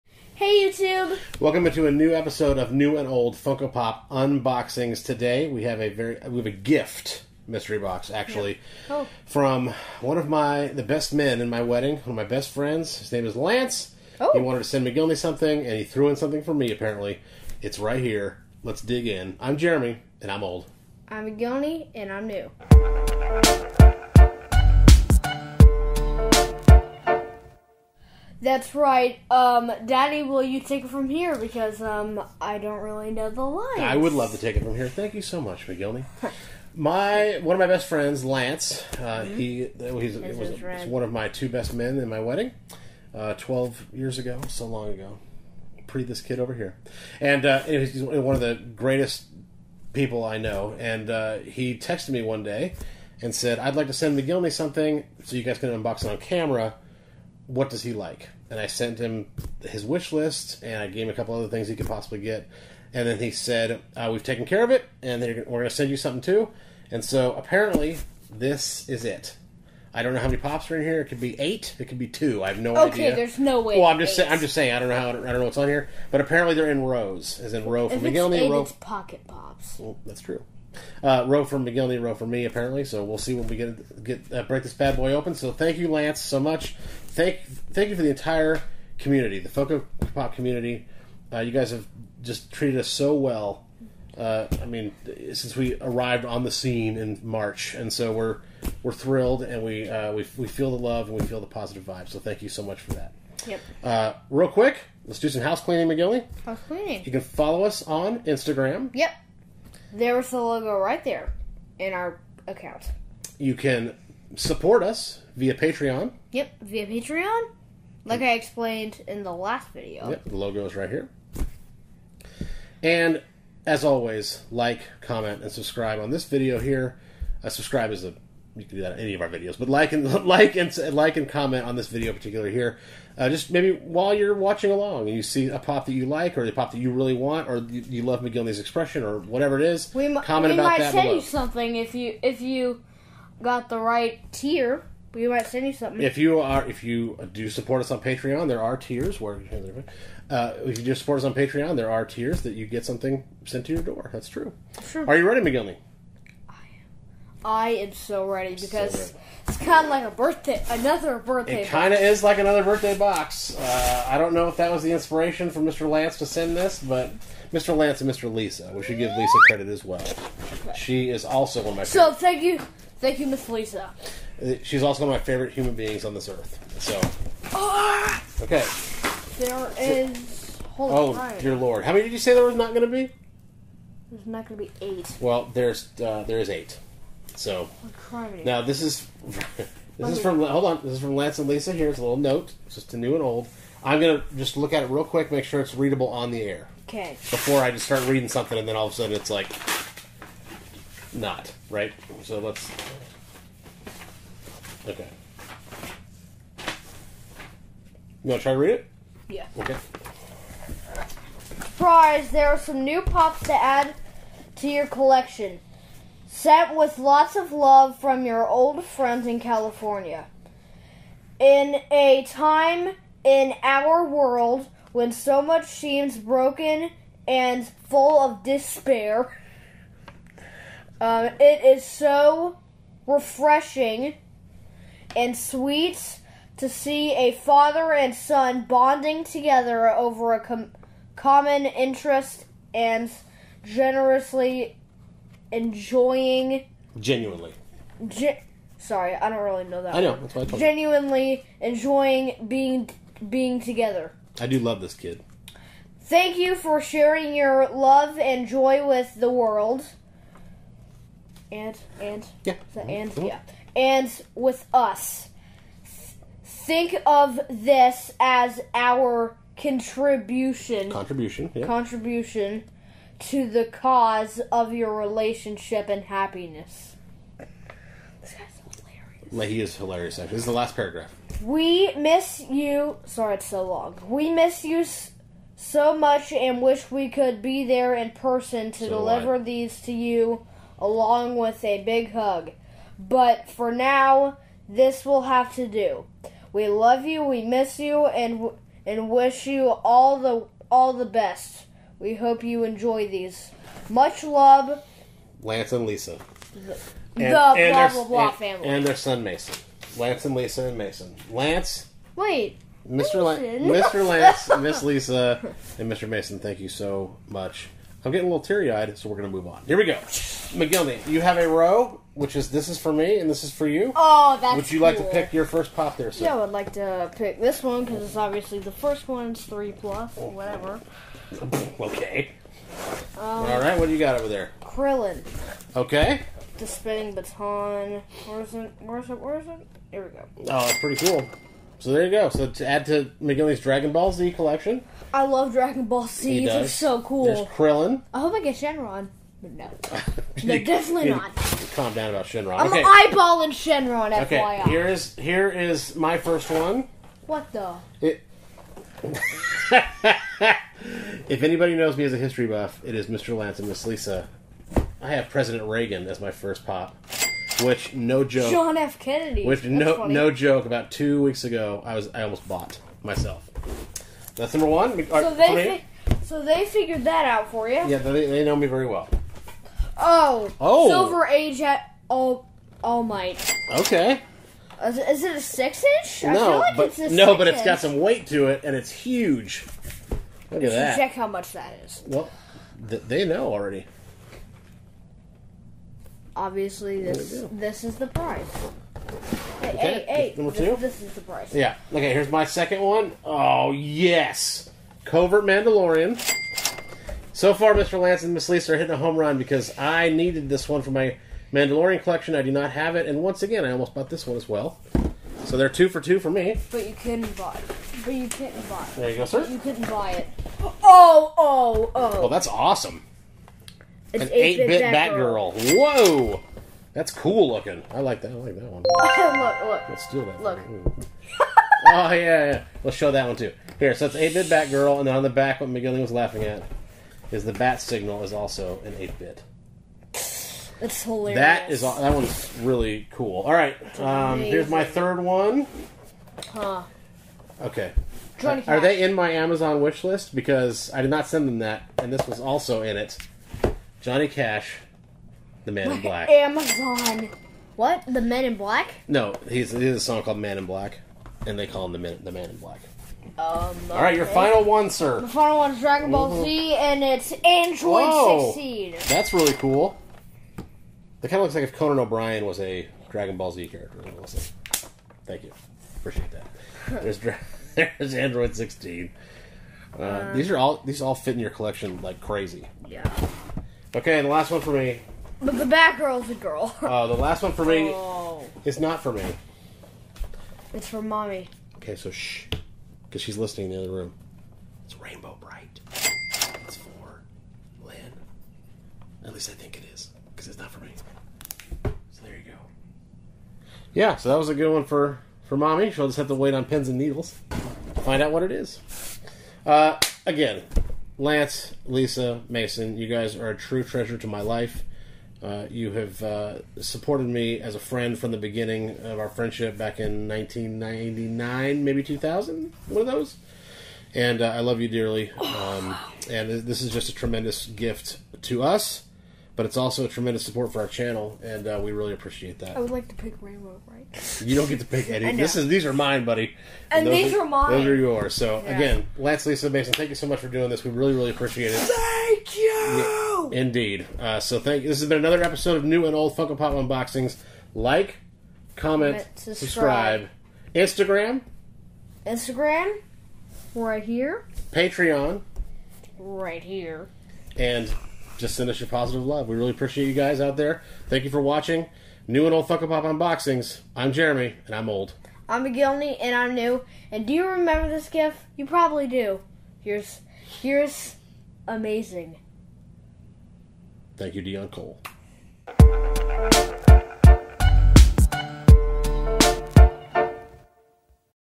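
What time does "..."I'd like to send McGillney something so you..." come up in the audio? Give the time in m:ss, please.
0:53.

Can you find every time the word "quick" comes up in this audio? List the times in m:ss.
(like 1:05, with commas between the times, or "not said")
1:44, 3:15.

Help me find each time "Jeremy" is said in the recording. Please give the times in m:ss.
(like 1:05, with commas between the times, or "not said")
0:19, 9:24.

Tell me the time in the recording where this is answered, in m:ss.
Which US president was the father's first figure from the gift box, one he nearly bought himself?
6:05.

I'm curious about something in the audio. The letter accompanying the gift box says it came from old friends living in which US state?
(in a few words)
California.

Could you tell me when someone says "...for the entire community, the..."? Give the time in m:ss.
1:27.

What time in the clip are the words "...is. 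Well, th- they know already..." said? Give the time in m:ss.
6:31.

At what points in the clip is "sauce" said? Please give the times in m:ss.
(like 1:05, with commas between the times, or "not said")
not said.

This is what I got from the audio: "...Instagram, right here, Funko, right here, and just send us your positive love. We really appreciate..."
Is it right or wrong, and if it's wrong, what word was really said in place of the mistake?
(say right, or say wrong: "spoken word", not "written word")
wrong: "Patreon", not "Funko".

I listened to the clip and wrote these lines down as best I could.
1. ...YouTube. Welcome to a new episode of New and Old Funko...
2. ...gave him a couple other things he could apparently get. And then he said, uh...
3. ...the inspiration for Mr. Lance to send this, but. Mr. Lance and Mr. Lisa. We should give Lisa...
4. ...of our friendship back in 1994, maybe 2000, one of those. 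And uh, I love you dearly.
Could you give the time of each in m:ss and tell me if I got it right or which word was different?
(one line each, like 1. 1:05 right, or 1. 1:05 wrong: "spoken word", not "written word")
1. 0:00 right
2. 1:00 wrong: "possibly", not "apparently"
3. 2:44 right
4. 8:39 wrong: "1999", not "1994".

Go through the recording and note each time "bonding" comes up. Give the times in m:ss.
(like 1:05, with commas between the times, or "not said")
3:58.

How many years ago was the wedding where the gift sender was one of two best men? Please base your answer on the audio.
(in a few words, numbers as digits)
12.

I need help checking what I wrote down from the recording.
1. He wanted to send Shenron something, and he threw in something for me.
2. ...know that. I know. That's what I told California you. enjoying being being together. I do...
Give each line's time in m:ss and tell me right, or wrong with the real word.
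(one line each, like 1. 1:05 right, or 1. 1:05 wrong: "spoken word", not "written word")
1. 0:14 wrong: "McGillney", not "Shenron"
2. 4:09 wrong: "Genuinely", not "California".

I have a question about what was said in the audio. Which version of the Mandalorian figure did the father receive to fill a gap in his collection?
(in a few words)
Covert Mandalorian.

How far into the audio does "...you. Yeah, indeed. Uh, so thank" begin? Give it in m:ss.
9:02.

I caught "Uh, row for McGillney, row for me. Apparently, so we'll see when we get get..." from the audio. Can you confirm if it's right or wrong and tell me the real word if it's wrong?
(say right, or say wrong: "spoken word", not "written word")
right.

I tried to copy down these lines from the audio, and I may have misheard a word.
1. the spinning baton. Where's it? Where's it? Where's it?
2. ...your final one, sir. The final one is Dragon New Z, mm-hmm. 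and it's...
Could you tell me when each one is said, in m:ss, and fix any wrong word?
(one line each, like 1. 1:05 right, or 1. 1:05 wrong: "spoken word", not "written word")
1. 5:36 right
2. 7:44 wrong: "Ball", not "New".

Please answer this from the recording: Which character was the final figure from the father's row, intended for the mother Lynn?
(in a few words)
Rainbow Brite.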